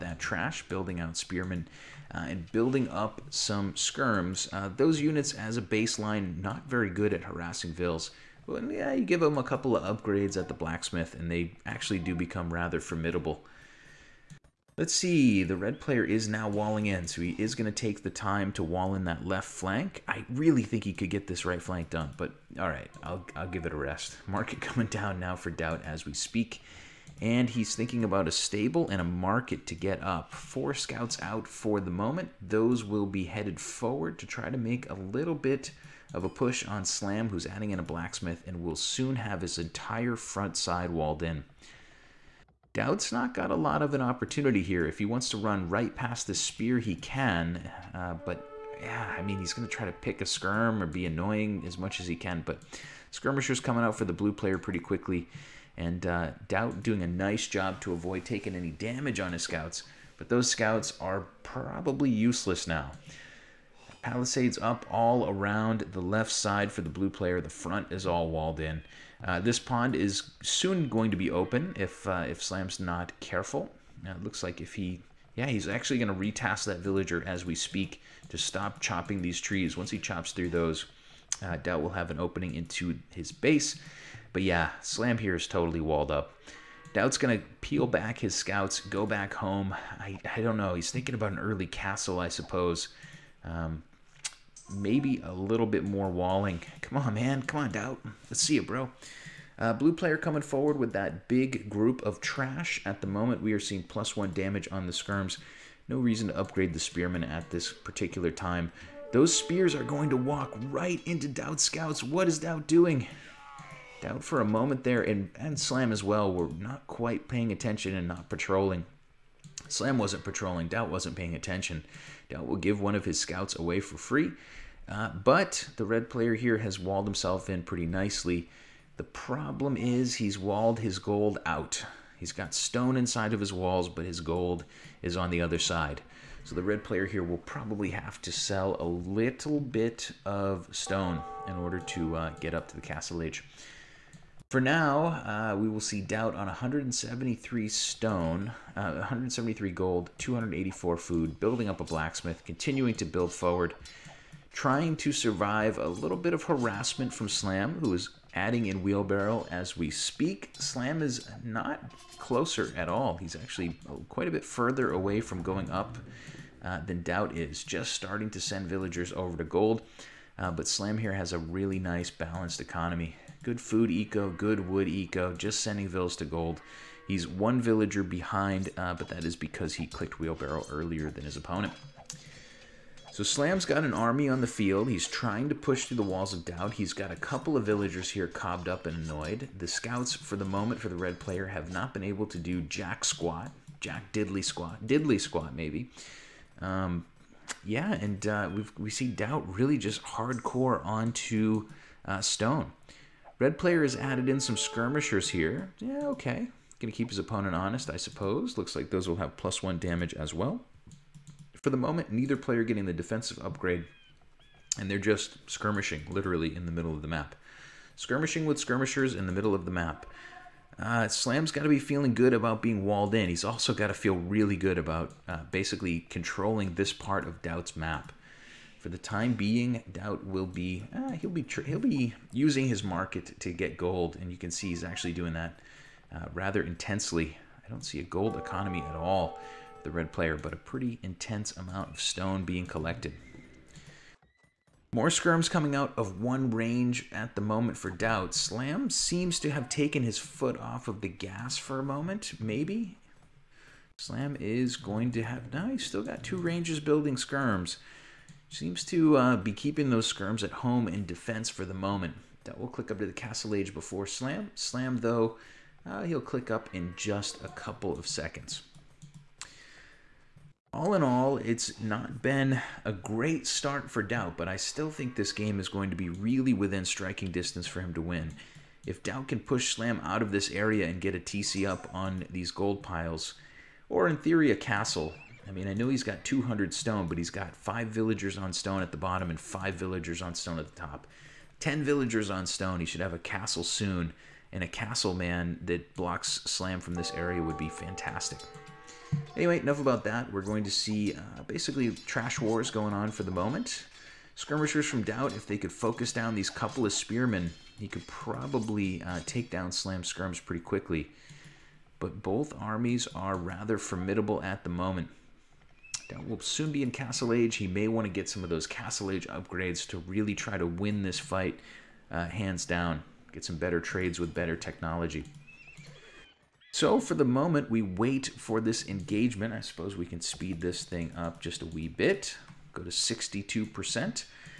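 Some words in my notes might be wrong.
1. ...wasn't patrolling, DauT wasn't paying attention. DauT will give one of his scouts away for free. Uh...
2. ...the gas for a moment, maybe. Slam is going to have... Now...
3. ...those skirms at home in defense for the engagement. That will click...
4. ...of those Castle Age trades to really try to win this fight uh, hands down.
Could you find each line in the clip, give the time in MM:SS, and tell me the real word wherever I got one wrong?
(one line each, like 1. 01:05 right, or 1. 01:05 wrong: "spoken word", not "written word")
1. 01:59 right
2. 04:10 right
3. 04:19 wrong: "moment", not "engagement"
4. 05:18 wrong: "upgrades", not "trades".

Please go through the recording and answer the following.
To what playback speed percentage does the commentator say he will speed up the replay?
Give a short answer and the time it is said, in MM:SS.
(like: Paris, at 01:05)
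62%, at 05:32.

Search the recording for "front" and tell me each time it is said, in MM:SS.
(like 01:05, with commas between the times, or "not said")
00:40, 01:07.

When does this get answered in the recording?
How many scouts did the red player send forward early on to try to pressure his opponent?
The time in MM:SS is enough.
00:30.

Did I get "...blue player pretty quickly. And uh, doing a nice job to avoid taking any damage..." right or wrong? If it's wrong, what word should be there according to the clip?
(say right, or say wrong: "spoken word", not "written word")
right.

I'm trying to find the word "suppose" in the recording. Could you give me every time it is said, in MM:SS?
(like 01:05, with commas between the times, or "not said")
01:32, 03:27, 05:29.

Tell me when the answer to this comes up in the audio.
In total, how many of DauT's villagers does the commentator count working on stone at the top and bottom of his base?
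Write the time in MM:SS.
04:51.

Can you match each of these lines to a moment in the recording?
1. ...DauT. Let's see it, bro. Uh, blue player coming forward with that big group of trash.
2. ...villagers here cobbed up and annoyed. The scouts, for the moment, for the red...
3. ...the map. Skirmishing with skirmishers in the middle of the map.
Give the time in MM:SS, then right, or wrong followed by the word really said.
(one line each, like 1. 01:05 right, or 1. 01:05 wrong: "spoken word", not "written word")
1. 01:37 right
2. 03:07 right
3. 03:37 right.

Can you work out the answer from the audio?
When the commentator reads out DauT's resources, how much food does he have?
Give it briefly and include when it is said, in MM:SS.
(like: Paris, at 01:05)
284, at 02:30.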